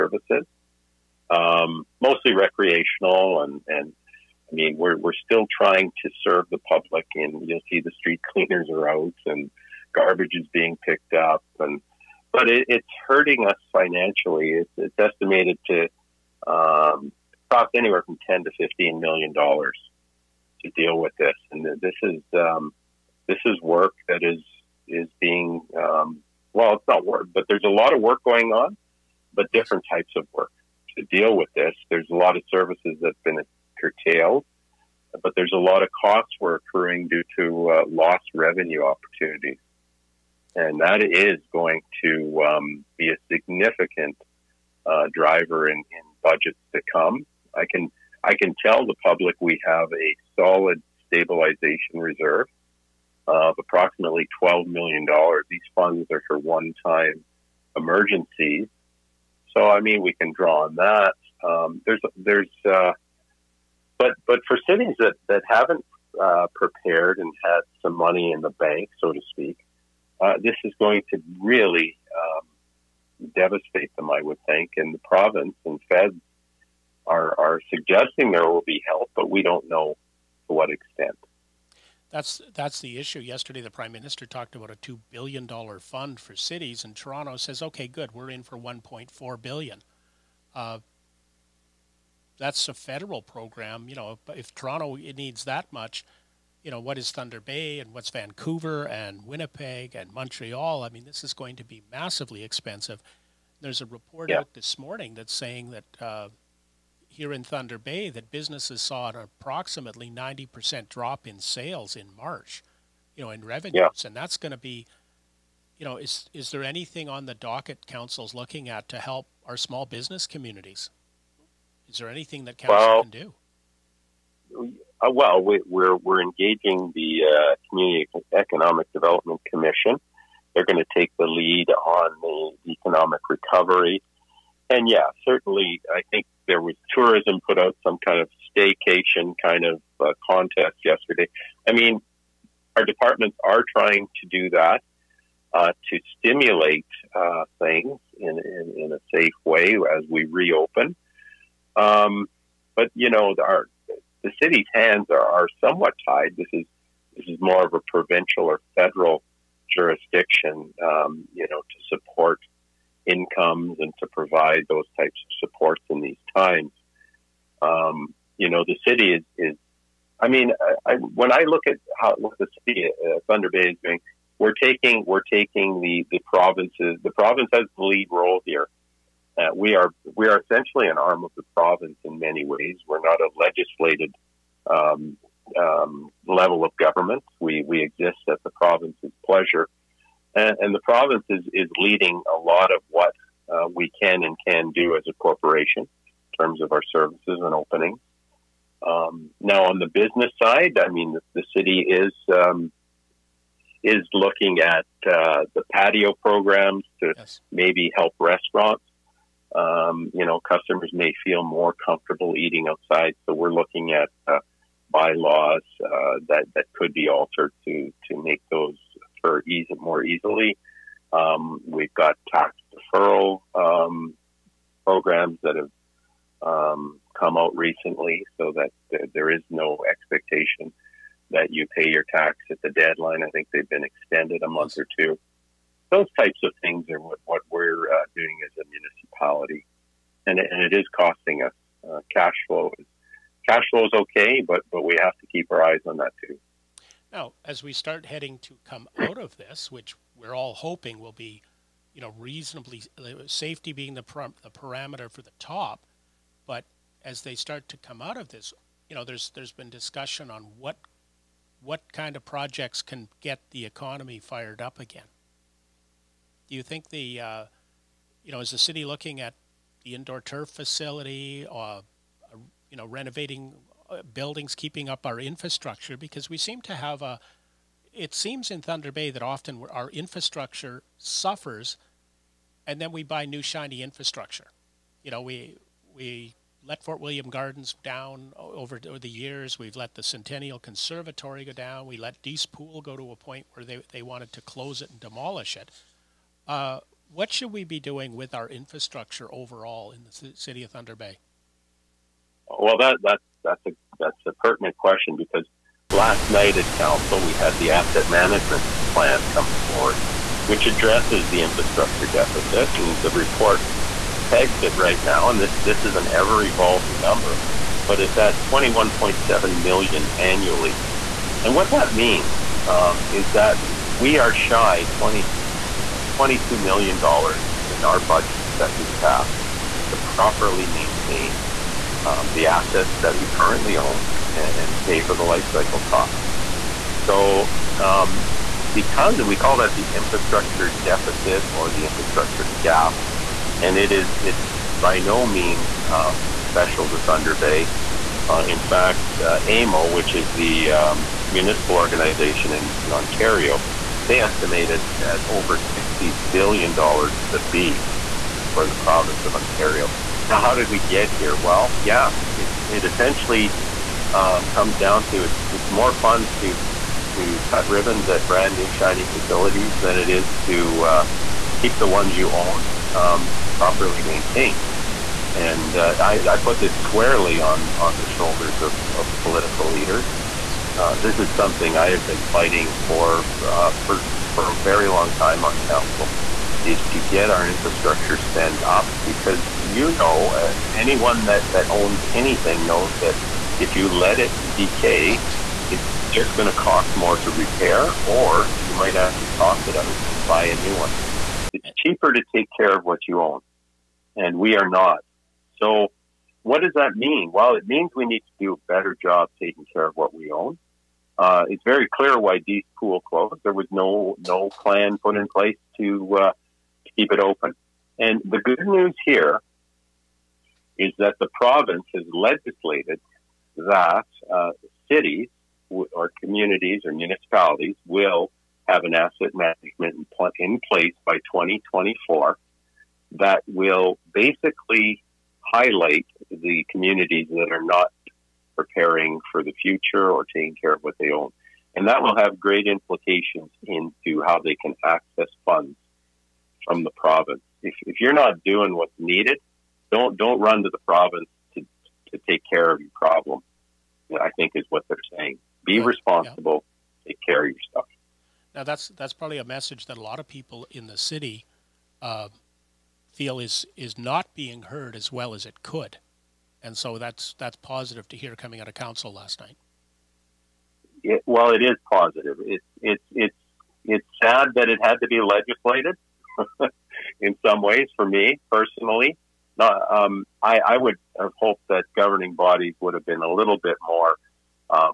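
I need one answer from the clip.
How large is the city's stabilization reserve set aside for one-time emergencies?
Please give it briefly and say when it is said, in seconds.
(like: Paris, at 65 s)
$12 million, at 54 s.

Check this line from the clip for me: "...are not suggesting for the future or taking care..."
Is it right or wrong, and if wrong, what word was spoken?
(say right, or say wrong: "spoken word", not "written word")
wrong: "preparing", not "suggesting".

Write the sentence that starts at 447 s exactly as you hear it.
If, if you're not doing what's needed, don't don't run to the province to, to take care of your problem.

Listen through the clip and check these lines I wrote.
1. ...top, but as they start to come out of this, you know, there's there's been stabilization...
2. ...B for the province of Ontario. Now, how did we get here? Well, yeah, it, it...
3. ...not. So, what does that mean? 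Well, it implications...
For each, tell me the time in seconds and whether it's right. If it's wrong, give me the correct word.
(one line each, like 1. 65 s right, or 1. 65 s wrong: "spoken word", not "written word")
1. 255 s wrong: "discussion", not "stabilization"
2. 357 s right
3. 404 s wrong: "means", not "implications".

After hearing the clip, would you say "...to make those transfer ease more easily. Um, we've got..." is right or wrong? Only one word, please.
right.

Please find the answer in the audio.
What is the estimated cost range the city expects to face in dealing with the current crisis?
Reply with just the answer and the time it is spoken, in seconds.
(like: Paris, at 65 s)
$10 to $15 million, at 18 s.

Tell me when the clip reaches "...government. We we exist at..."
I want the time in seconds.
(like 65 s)
186 s.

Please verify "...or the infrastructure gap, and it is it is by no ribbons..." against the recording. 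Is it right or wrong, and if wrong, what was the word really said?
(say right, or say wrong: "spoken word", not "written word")
wrong: "means", not "ribbons".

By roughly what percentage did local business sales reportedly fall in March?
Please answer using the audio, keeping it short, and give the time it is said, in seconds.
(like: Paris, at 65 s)
90%, at 110 s.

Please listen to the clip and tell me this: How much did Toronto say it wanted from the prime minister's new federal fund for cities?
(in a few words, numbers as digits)
1.4 billion.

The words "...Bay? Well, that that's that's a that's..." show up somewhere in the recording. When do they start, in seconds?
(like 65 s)
300 s.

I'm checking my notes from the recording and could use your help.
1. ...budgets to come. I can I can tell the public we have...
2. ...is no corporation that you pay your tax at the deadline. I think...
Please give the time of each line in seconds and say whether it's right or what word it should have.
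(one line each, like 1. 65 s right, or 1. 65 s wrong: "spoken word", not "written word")
1. 46 s right
2. 229 s wrong: "expectation", not "corporation".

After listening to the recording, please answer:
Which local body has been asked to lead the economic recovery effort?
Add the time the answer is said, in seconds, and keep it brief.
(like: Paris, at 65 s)
Community Economic Development Commission, at 127 s.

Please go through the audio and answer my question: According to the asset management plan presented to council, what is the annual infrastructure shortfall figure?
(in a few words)
21.7 million.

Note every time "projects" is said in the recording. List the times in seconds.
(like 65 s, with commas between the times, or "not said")
262 s.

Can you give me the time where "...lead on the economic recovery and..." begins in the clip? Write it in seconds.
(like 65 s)
131 s.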